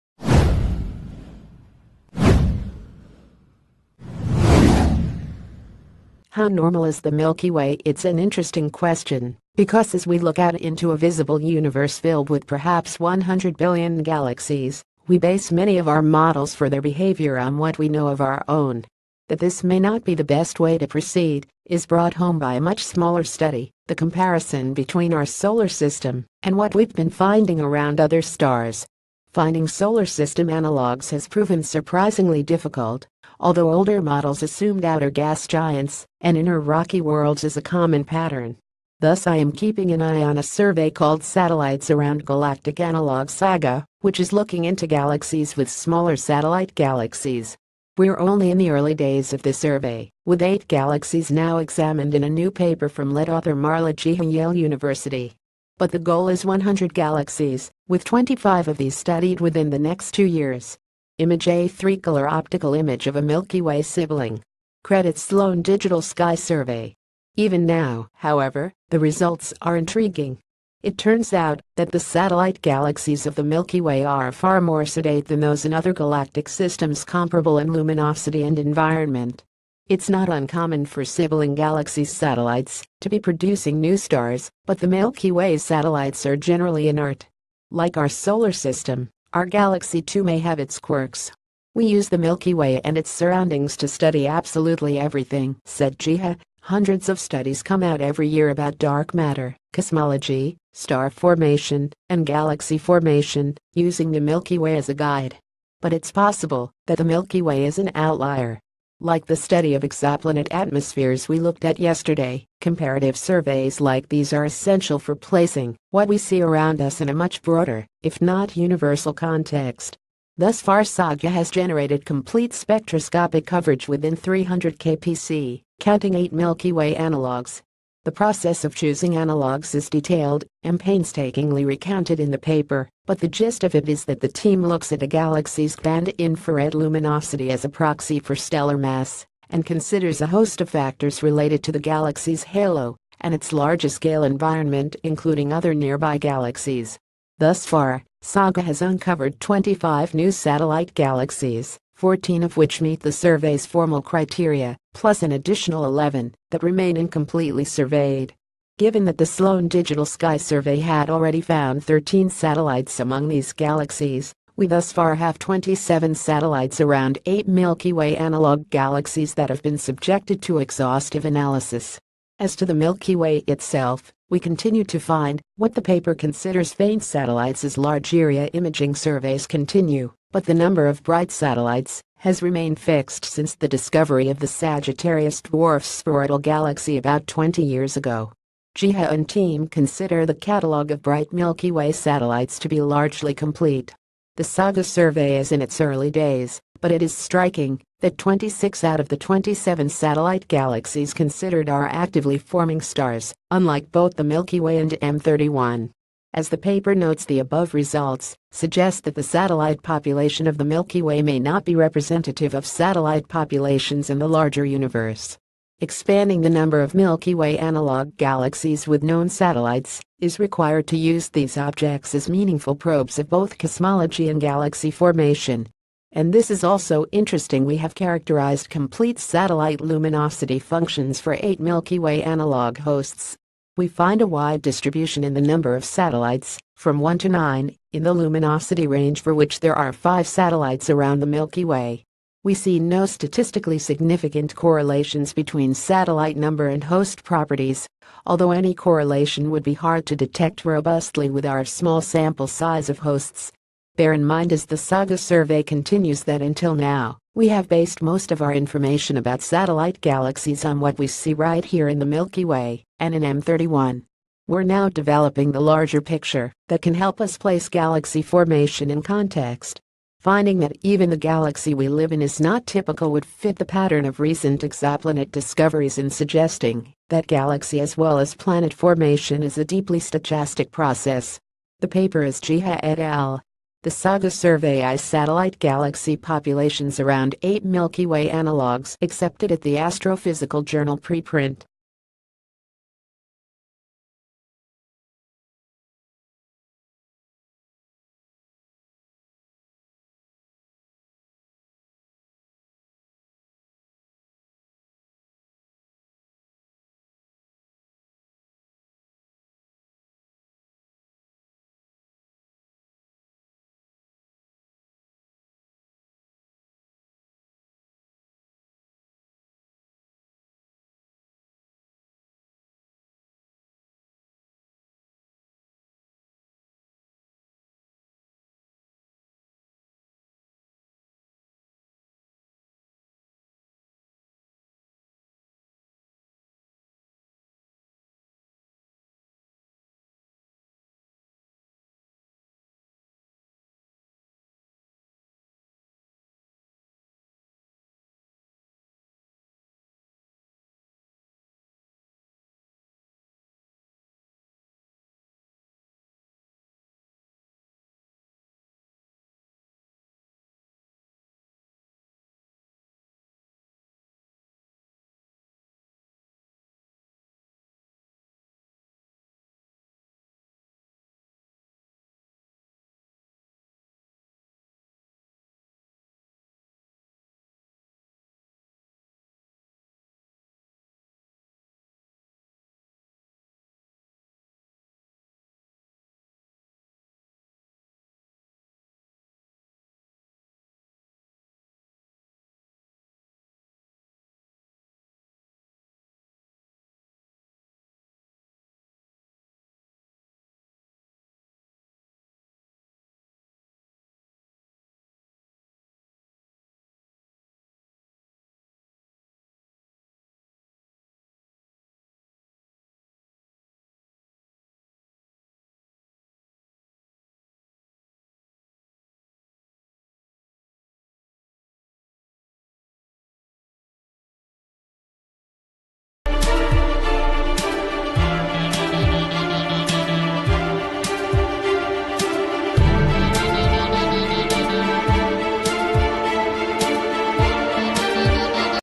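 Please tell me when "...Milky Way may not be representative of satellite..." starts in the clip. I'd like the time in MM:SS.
03:30.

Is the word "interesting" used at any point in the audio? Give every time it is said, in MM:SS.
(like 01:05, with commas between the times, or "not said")
00:08, 03:47.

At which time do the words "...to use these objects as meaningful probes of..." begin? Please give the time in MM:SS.
03:40.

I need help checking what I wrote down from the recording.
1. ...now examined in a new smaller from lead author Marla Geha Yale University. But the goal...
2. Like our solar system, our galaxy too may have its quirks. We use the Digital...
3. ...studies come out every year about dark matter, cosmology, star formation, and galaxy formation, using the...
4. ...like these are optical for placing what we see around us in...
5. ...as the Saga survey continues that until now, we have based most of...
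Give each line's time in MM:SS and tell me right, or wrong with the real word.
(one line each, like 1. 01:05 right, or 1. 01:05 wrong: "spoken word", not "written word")
1. 00:51 wrong: "paper", not "smaller"
2. 01:27 wrong: "Milky", not "Digital"
3. 01:37 right
4. 01:53 wrong: "essential", not "optical"
5. 04:14 right.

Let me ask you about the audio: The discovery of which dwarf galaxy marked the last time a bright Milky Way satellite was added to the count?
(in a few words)
Sagittarius dwarf spheroidal galaxy.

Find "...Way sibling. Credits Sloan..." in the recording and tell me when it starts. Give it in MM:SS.
01:03.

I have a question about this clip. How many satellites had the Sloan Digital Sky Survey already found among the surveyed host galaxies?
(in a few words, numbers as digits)
13.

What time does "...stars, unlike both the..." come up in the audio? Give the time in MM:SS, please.
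03:22.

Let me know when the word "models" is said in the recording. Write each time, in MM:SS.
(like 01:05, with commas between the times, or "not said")
00:16, 00:34.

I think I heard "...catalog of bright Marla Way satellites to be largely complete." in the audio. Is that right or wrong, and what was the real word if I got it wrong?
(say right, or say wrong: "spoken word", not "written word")
wrong: "Milky", not "Marla".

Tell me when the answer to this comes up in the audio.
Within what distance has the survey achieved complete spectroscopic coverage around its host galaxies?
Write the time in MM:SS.
02:04.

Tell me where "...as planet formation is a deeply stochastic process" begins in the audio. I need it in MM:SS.
04:38.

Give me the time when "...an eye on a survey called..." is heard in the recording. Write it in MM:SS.
00:39.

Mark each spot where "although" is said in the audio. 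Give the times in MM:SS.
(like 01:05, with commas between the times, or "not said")
00:33, 04:08.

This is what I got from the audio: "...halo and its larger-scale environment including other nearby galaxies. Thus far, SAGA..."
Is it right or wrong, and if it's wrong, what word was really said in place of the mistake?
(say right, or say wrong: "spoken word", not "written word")
right.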